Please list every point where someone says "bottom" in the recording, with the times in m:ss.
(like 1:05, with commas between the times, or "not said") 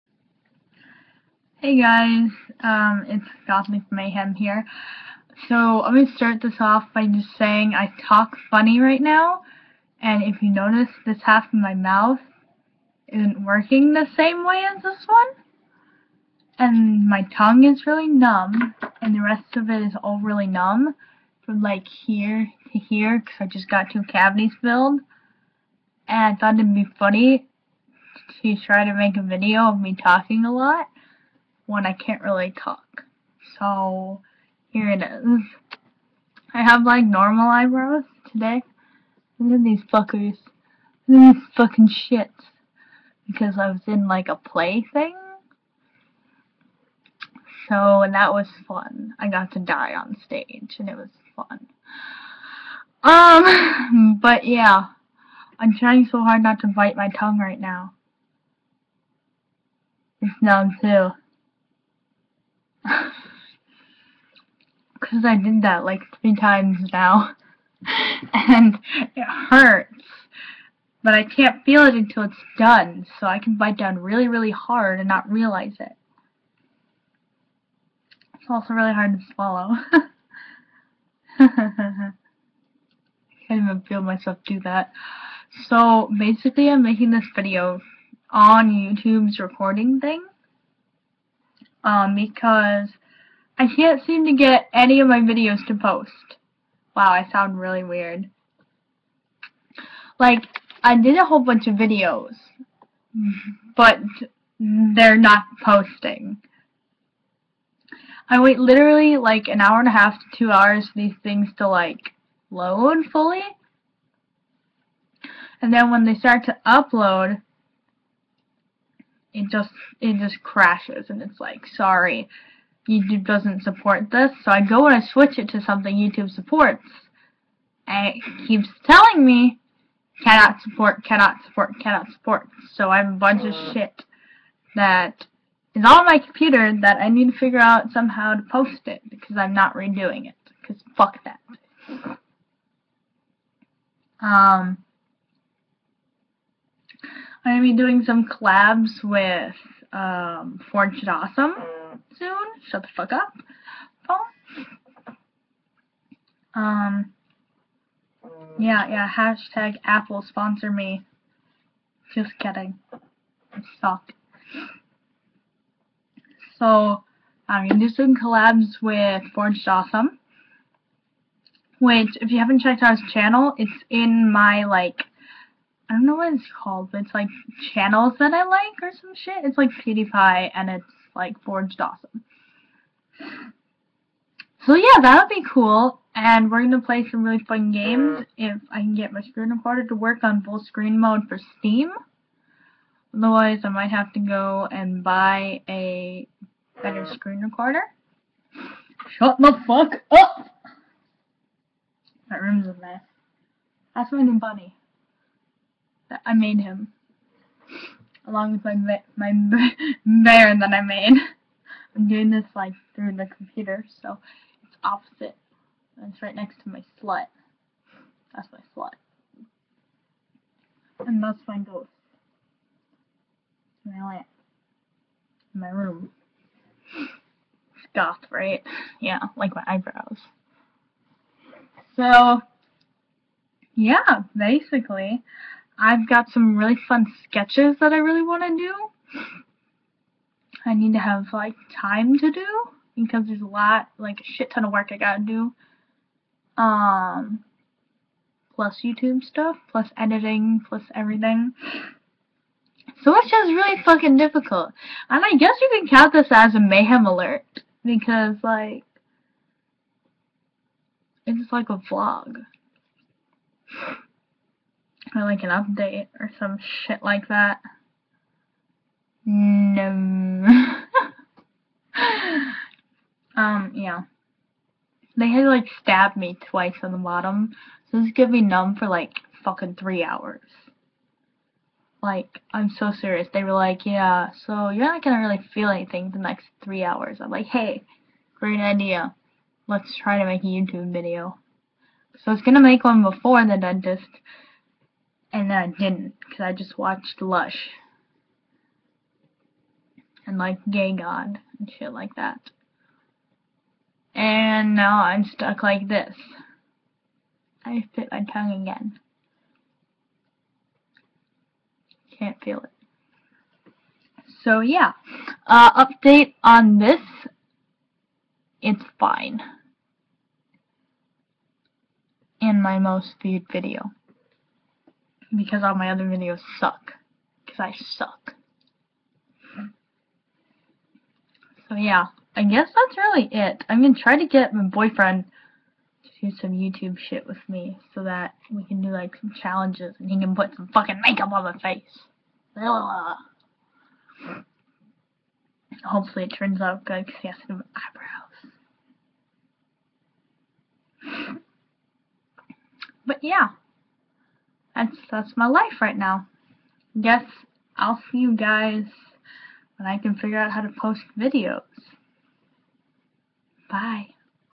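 4:36.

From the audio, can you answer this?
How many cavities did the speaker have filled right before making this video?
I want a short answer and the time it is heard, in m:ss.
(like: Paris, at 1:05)
2, at 0:23.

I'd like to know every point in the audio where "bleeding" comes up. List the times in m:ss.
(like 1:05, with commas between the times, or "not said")
not said.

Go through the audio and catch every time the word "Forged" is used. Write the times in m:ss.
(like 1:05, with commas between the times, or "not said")
2:49, 3:01.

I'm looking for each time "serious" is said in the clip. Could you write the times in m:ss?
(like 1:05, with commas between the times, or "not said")
4:42.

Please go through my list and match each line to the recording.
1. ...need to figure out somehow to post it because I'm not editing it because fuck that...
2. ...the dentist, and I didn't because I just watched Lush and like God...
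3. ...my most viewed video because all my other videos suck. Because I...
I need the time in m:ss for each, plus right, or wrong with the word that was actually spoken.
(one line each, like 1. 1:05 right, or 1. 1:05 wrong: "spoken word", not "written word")
1. 2:17 wrong: "redoing", not "editing"
2. 4:53 wrong: "Gay", not "God"
3. 5:22 right.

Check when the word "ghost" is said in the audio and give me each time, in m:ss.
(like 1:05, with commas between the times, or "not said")
3:41.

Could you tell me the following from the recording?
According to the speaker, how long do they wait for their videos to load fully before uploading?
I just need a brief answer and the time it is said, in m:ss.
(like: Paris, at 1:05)
An hour and a half to two hours, at 1:49.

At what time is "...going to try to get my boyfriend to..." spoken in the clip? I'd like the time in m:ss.
5:33.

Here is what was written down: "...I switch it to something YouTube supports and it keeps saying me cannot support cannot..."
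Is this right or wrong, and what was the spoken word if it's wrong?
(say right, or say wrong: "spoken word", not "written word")
wrong: "telling", not "saying".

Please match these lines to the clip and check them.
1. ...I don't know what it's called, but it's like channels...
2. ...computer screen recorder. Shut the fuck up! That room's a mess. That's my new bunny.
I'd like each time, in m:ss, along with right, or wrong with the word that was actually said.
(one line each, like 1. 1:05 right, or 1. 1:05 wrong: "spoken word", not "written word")
1. 2:55 right
2. 3:16 wrong: "better", not "computer".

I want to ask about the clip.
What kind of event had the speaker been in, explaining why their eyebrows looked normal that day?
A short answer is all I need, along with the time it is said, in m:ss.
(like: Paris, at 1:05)
A play, at 0:44.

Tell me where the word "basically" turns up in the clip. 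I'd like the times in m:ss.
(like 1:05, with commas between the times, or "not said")
1:26, 3:54.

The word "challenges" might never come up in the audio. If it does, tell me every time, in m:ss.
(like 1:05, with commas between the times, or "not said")
5:39.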